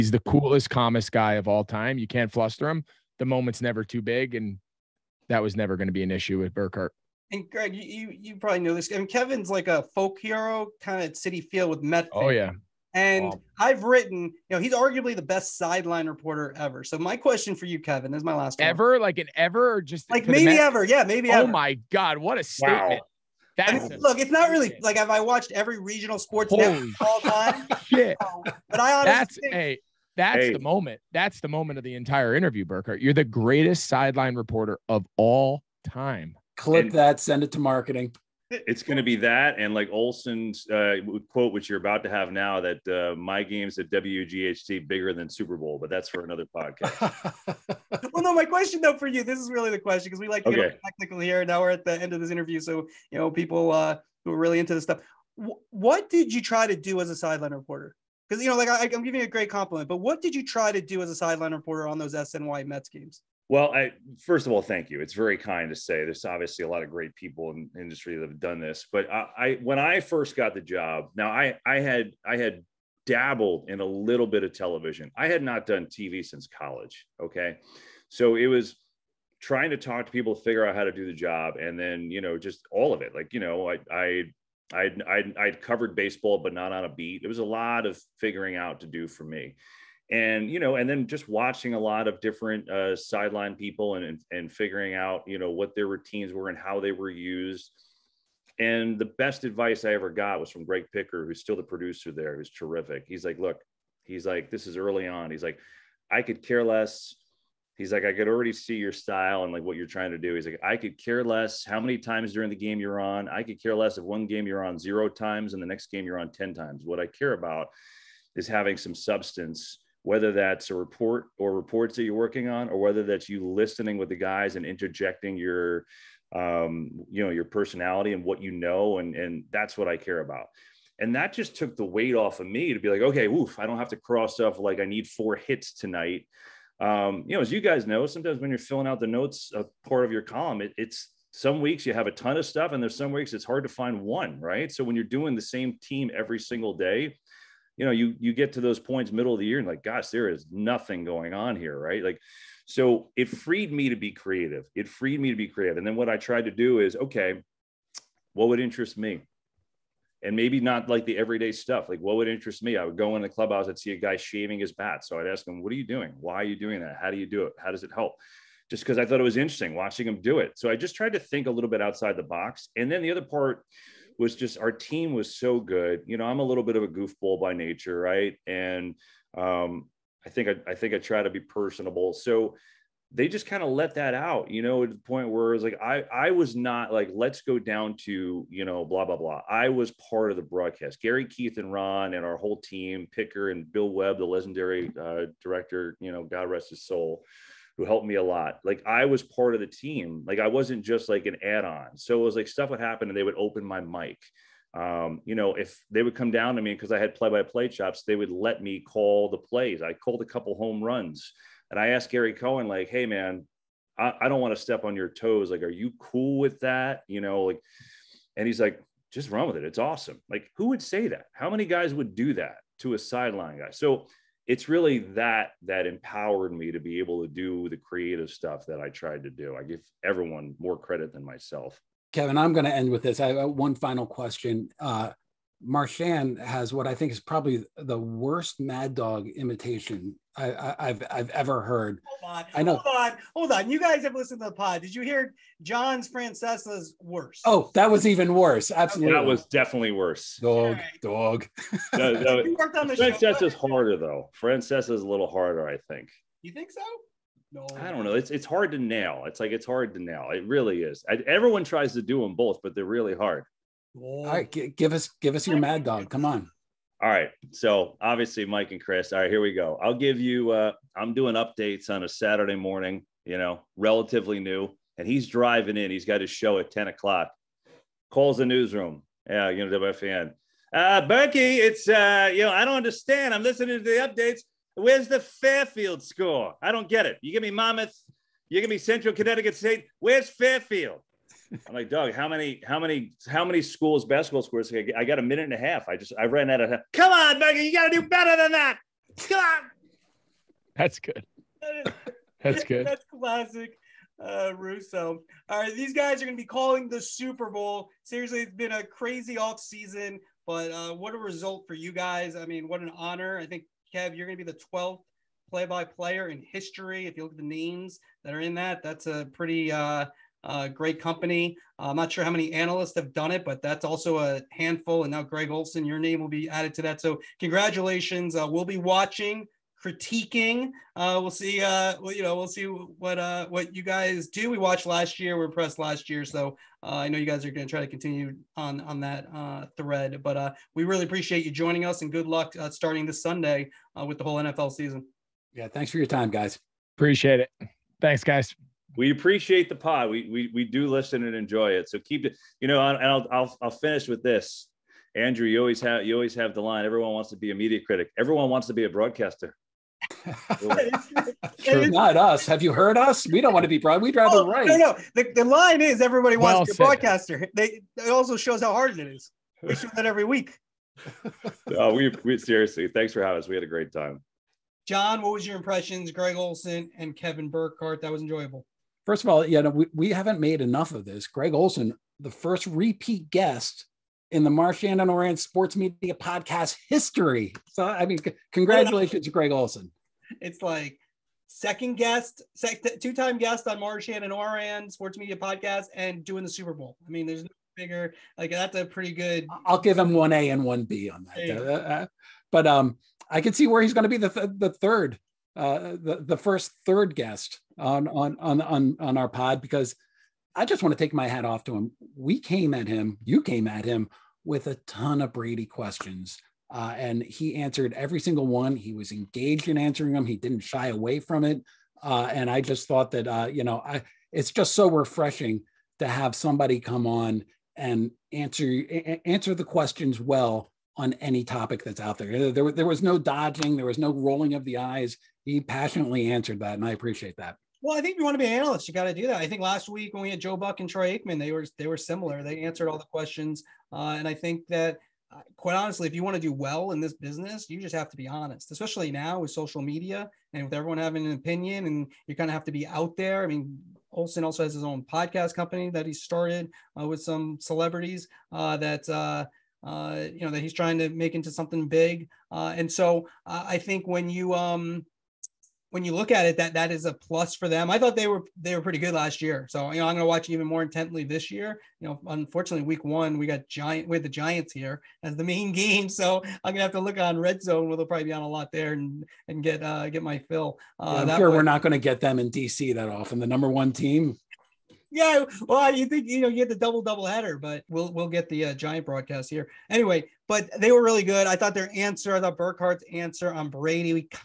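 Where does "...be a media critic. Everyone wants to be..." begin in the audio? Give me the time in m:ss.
5:57.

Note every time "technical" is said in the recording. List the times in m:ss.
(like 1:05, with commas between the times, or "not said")
0:50.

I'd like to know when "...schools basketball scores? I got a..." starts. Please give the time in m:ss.
4:53.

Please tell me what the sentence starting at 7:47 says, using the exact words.
I thought they were they were pretty good last year, so you know I'm going to watch even more intently this year.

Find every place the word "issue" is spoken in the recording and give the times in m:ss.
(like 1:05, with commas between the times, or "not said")
0:06.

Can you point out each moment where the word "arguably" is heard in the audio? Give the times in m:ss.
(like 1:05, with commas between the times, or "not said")
0:14.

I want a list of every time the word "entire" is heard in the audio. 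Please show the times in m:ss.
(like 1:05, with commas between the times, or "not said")
0:31.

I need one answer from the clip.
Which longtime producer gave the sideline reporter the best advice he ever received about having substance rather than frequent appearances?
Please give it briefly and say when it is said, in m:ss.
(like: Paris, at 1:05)
Greg Picker, at 1:40.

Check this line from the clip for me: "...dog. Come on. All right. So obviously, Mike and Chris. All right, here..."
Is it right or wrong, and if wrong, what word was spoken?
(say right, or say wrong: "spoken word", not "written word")
right.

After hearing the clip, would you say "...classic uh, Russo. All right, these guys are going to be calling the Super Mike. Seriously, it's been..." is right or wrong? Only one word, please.
wrong.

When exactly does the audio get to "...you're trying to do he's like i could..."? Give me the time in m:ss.
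1:49.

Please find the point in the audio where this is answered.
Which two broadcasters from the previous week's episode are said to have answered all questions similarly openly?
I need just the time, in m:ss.
7:20.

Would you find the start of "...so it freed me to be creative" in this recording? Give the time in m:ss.
2:32.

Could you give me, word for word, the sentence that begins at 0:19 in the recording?
like an ever, or just like maybe ever, yeah, maybe.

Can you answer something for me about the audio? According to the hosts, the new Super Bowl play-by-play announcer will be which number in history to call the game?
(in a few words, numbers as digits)
12th.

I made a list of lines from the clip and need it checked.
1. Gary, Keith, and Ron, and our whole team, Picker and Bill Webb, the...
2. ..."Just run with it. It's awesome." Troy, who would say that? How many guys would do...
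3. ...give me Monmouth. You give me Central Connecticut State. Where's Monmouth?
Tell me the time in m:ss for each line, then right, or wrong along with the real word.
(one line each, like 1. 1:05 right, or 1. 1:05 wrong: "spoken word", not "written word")
1. 3:11 right
2. 3:39 wrong: "Like", not "Troy"
3. 4:47 wrong: "Fairfield", not "Monmouth".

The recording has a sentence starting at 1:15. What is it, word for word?
I had not done TV since college.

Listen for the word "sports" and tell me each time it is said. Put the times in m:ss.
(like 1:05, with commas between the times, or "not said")
0:26, 6:25, 6:34.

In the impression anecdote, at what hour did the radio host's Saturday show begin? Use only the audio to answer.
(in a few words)
10 o'clock.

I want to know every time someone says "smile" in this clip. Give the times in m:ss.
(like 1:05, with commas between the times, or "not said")
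not said.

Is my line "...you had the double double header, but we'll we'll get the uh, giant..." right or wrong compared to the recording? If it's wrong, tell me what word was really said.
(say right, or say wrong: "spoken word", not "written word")
right.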